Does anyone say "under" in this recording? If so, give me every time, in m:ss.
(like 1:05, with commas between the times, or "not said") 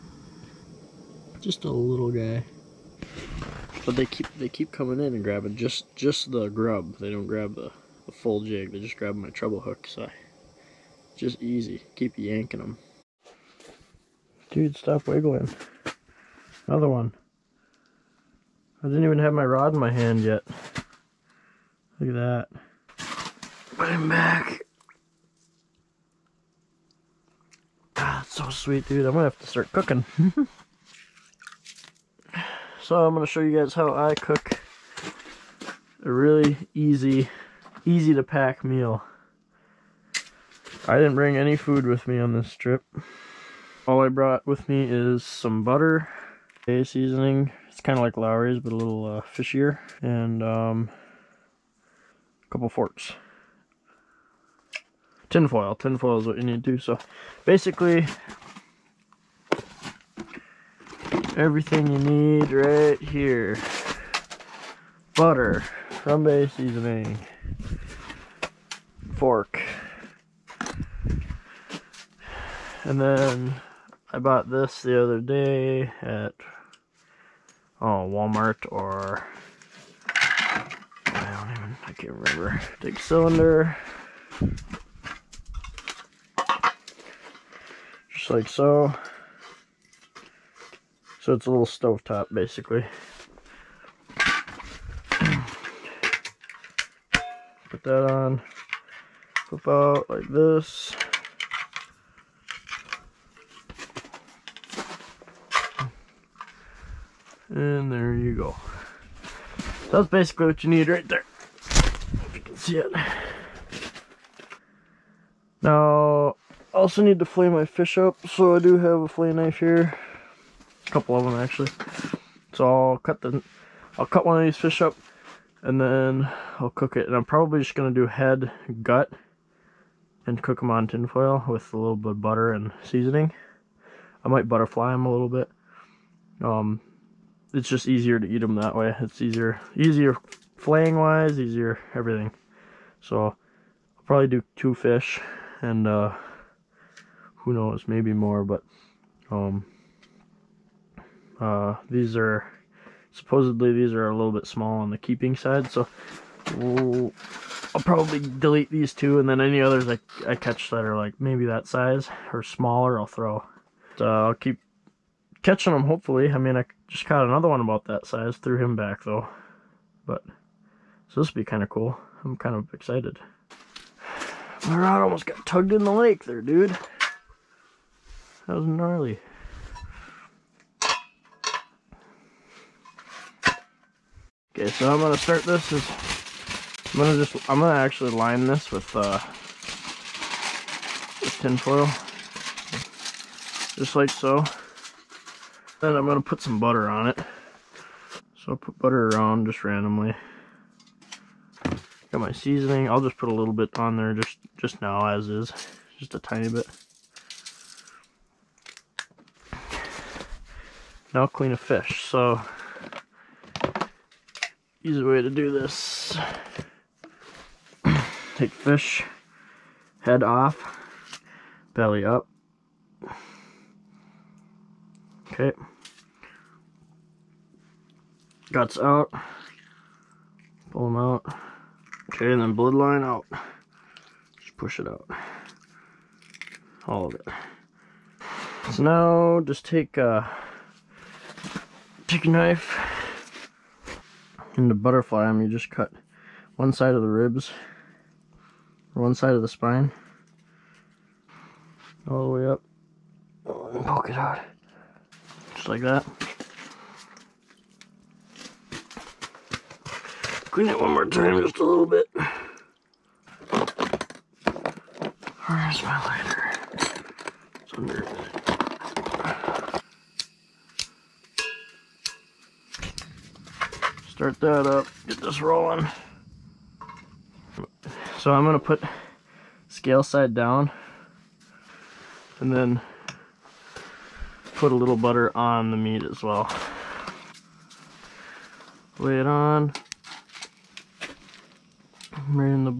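4:27.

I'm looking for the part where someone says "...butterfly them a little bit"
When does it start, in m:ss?
2:14.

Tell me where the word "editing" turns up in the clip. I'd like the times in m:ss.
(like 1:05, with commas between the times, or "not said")
not said.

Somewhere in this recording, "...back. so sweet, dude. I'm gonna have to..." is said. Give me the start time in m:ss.
0:24.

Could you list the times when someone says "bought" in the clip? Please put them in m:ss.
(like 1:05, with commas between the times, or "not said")
1:14.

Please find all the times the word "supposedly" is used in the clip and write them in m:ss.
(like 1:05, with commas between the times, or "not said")
2:33.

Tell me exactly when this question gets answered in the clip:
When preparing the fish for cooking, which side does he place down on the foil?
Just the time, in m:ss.
4:39.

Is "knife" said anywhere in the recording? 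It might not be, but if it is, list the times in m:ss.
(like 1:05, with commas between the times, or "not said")
1:59, 4:02.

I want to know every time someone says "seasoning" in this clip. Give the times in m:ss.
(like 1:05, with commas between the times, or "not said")
0:46, 1:06, 2:12, 3:22.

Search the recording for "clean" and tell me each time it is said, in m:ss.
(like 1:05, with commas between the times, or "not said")
3:31, 4:20.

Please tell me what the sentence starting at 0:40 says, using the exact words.
I didn't bring any food with me on this trip.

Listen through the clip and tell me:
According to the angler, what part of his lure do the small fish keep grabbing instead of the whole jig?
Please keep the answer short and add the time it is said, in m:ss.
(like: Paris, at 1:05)
the grub, at 0:06.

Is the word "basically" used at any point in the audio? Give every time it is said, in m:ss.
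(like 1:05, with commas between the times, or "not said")
0:57, 1:32, 1:50.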